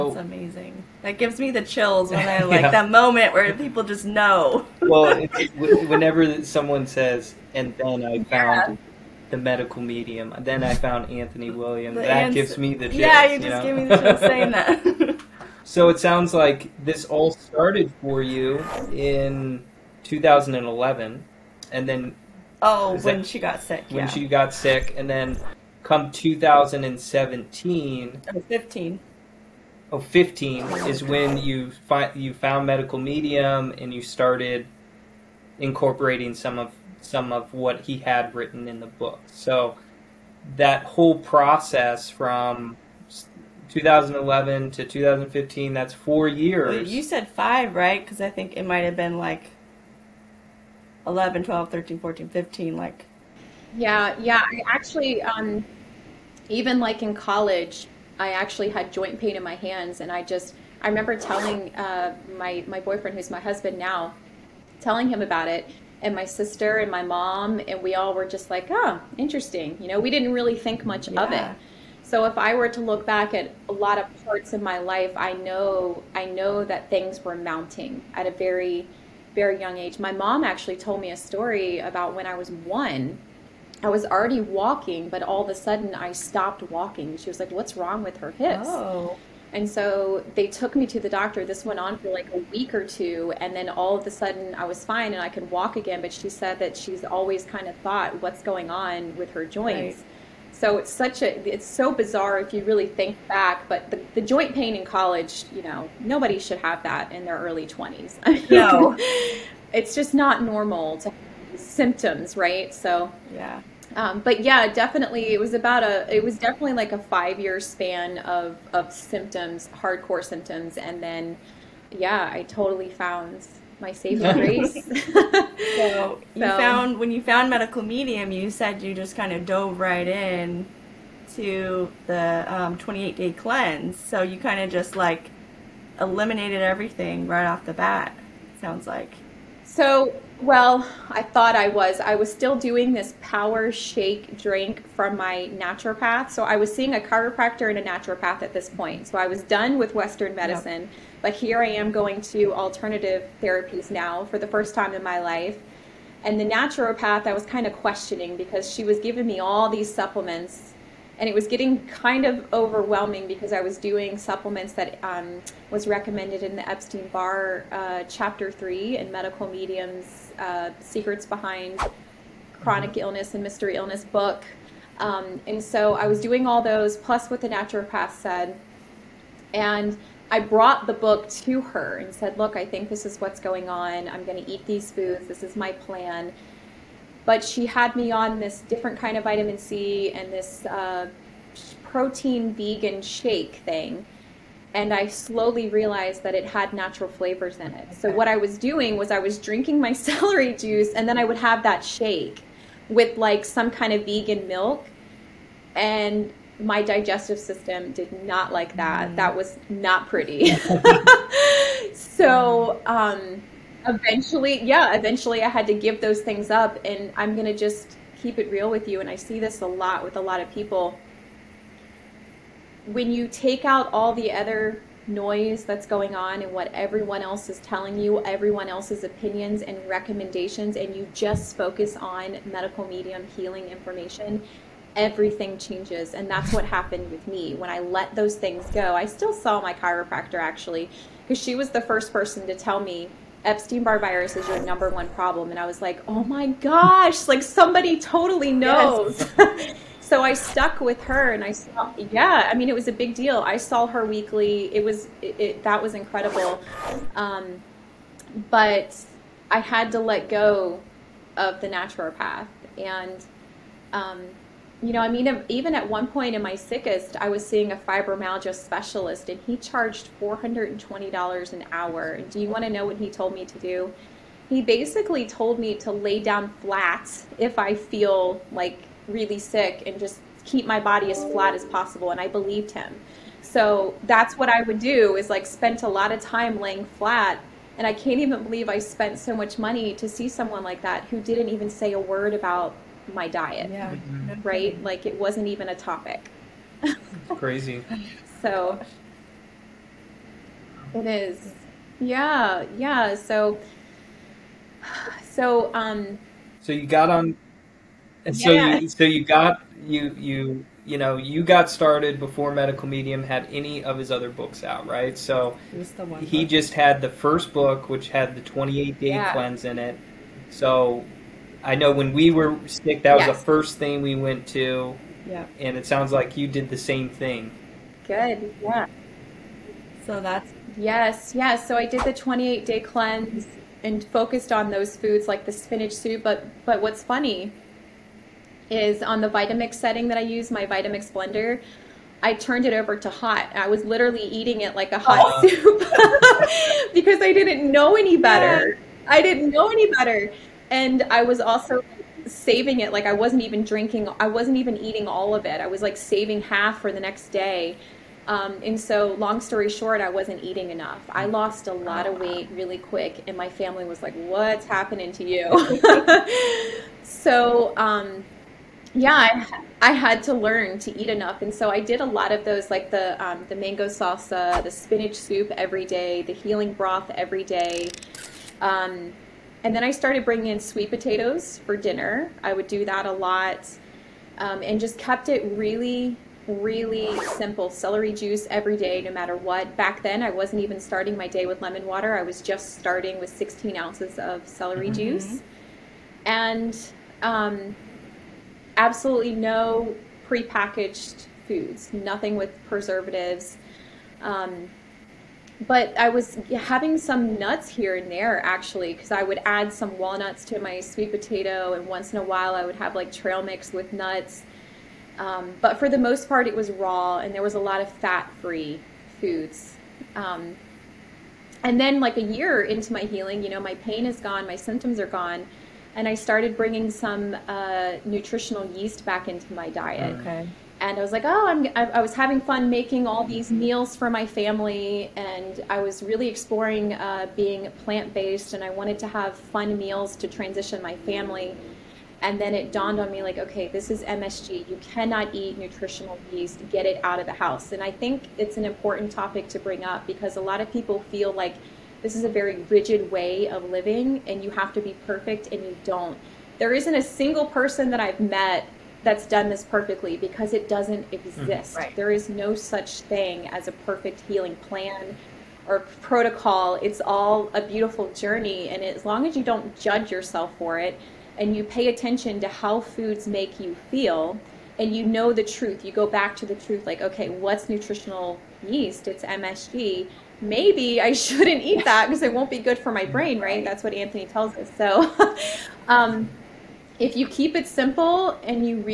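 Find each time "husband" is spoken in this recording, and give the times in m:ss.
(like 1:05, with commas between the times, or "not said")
1:03.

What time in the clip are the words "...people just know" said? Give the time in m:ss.
0:03.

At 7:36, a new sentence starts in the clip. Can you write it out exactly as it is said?
There isn't a single person that I've met that's done this perfectly because it doesn't mm-hmm.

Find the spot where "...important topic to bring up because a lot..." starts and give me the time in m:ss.
7:28.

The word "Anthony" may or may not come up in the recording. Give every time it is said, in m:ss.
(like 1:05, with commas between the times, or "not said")
0:11, 8:03.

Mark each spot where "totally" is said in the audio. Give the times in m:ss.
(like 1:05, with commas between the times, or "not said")
2:02, 4:07.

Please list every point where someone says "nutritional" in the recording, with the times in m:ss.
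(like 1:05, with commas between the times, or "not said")
7:08, 7:25, 7:57.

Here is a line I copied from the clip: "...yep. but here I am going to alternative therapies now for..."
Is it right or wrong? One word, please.
right.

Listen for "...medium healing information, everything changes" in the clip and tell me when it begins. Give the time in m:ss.
3:52.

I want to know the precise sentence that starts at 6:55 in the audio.
Um, but for the most part, it was raw and there was a lot of fat free foods.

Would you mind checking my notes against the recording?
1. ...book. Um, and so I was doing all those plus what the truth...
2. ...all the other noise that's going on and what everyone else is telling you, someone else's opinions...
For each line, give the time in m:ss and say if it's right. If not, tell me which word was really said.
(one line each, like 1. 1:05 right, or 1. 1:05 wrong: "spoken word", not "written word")
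1. 2:54 wrong: "naturopath", not "truth"
2. 3:43 wrong: "everyone", not "someone".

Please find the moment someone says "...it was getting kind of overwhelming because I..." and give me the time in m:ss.
2:41.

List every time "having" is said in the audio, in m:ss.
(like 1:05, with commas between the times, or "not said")
6:46, 7:12.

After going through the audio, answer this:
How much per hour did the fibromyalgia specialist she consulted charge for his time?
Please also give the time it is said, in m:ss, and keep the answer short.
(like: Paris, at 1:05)
$420, at 4:30.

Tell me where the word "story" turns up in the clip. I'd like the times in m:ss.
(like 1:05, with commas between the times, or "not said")
1:21, 5:59.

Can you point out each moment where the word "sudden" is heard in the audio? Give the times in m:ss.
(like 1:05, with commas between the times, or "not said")
1:25, 1:34.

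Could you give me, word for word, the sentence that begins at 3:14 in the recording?
And I slowly realized that it had natural flavors in it.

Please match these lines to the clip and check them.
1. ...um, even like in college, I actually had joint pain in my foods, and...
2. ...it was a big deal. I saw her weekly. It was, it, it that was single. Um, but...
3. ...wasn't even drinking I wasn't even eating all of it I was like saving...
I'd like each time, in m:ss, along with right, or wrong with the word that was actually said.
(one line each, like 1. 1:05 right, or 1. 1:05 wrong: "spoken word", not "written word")
1. 0:55 wrong: "hands", not "foods"
2. 4:12 wrong: "incredible", not "single"
3. 5:53 right.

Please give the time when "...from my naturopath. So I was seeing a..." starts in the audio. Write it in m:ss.
2:24.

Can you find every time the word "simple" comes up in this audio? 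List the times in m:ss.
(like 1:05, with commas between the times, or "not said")
6:27, 8:07.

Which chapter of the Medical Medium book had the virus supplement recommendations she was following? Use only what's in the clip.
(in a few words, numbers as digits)
Chapter Three.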